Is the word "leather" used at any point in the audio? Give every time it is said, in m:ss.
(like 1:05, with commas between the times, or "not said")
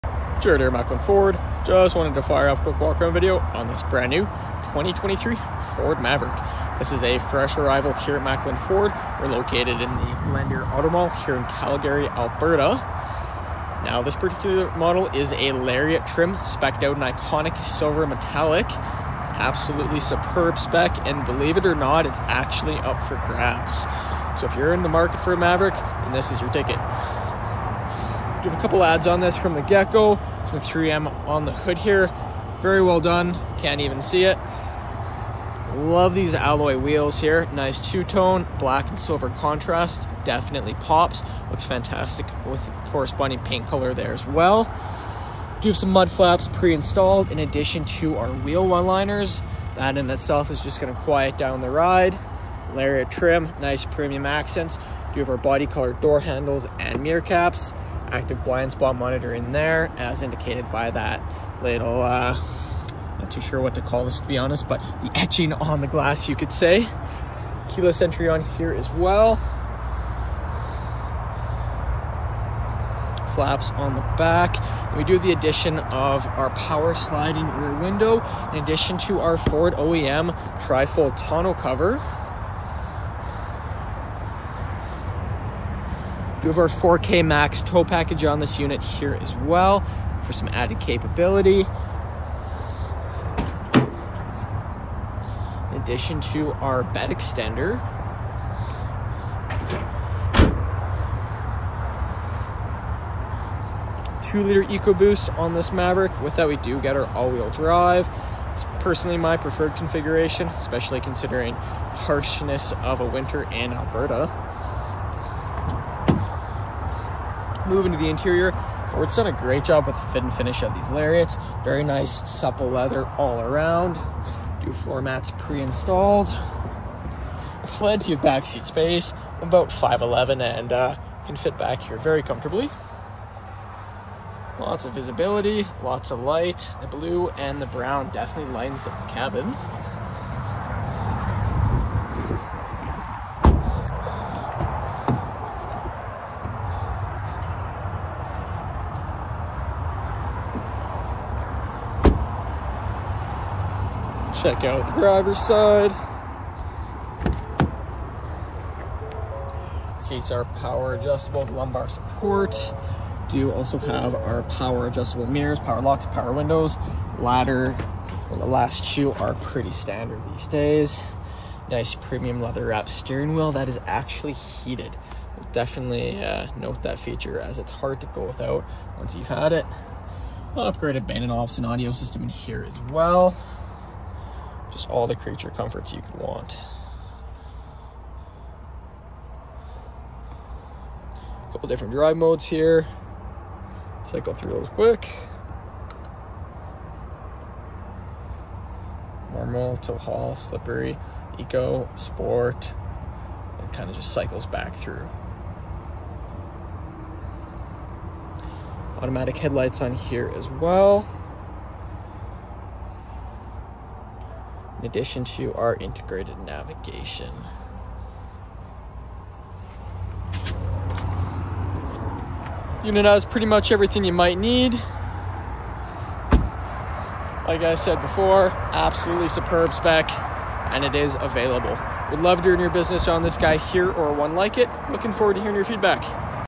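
2:02, 2:52.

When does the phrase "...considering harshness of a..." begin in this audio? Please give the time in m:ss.
1:51.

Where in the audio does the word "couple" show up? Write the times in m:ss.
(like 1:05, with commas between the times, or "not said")
0:28, 3:11.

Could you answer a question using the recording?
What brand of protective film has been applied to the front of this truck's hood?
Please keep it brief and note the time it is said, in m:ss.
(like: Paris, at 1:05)
3M, at 0:30.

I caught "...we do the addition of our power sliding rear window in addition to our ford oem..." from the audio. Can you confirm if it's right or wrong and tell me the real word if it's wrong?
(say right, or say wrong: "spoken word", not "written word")
right.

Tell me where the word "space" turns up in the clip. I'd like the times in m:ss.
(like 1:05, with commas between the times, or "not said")
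2:08.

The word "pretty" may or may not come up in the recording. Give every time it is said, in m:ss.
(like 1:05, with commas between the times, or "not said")
2:49, 3:43.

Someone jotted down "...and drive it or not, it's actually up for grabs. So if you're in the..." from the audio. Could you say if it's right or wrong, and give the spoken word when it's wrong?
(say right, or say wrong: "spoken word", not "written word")
wrong: "believe", not "drive".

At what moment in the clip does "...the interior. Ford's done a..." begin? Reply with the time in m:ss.
1:57.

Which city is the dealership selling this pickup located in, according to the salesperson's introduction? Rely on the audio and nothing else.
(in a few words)
Calgary.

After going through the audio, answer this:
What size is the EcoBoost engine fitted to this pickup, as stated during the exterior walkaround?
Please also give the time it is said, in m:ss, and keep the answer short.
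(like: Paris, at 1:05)
2 liter, at 1:44.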